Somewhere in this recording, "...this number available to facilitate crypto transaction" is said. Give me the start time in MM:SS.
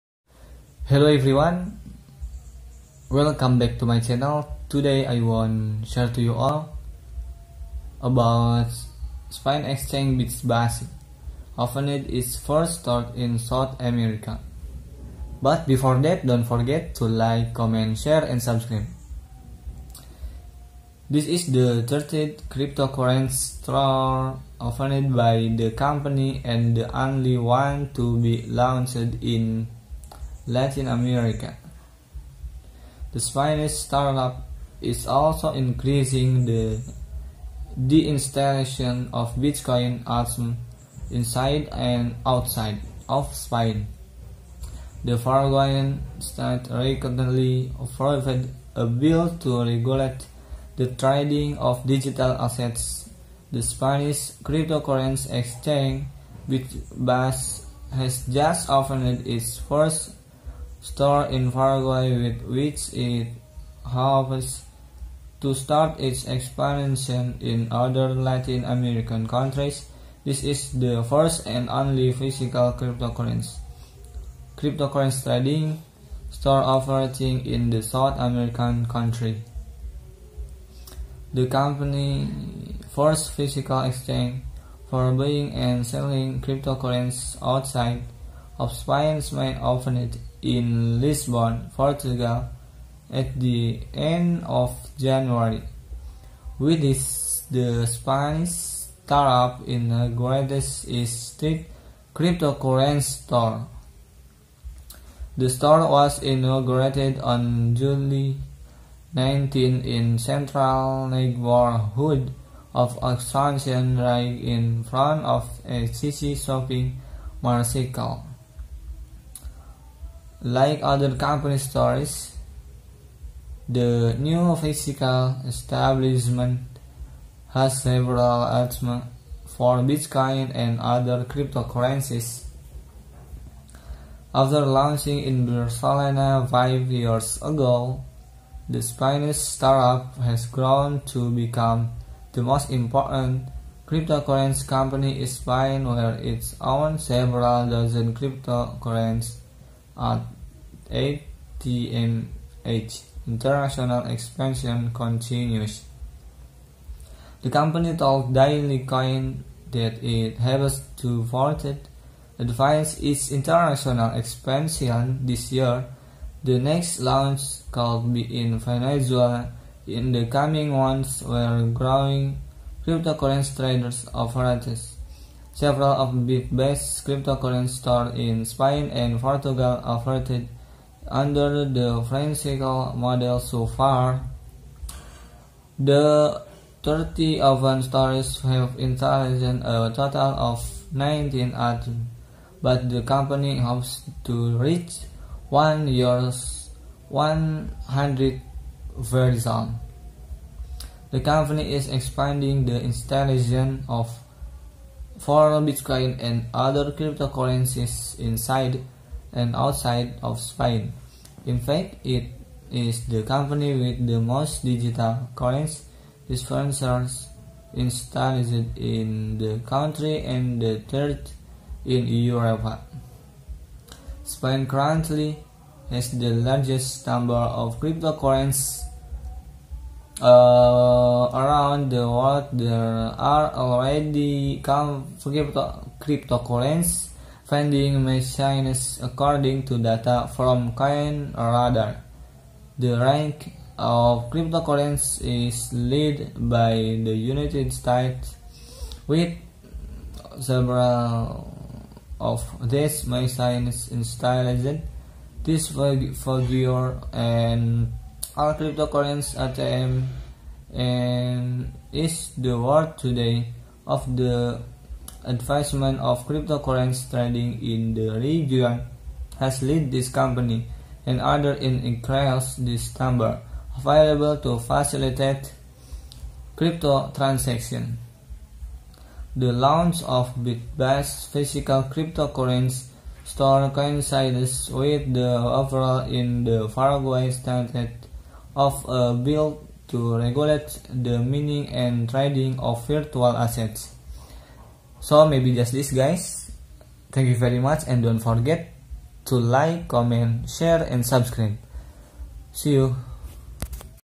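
04:32.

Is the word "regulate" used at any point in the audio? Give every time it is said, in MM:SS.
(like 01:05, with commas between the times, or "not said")
00:49, 04:50.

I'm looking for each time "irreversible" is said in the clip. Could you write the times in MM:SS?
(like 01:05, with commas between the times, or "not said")
not said.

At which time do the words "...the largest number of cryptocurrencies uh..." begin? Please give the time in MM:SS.
03:46.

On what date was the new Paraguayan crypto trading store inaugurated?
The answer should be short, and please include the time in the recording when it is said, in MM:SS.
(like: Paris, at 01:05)
July 19, at 01:47.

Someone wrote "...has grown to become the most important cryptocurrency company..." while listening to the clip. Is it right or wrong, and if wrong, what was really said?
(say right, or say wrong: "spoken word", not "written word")
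right.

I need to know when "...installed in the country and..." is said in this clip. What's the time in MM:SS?
03:37.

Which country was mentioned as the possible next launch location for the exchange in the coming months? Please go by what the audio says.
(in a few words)
Venezuela.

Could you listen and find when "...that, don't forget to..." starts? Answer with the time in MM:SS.
00:16.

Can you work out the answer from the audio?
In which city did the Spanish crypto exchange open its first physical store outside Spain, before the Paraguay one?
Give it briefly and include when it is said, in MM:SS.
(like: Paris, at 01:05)
Lisbon, at 01:30.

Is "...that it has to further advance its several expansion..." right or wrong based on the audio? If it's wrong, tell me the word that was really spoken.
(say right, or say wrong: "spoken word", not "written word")
wrong: "international", not "several".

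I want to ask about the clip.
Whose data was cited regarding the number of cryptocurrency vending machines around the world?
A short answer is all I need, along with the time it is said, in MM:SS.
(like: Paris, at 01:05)
Coin Radar, at 04:00.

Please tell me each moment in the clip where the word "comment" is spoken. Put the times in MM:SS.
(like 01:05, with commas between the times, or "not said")
00:17, 04:59.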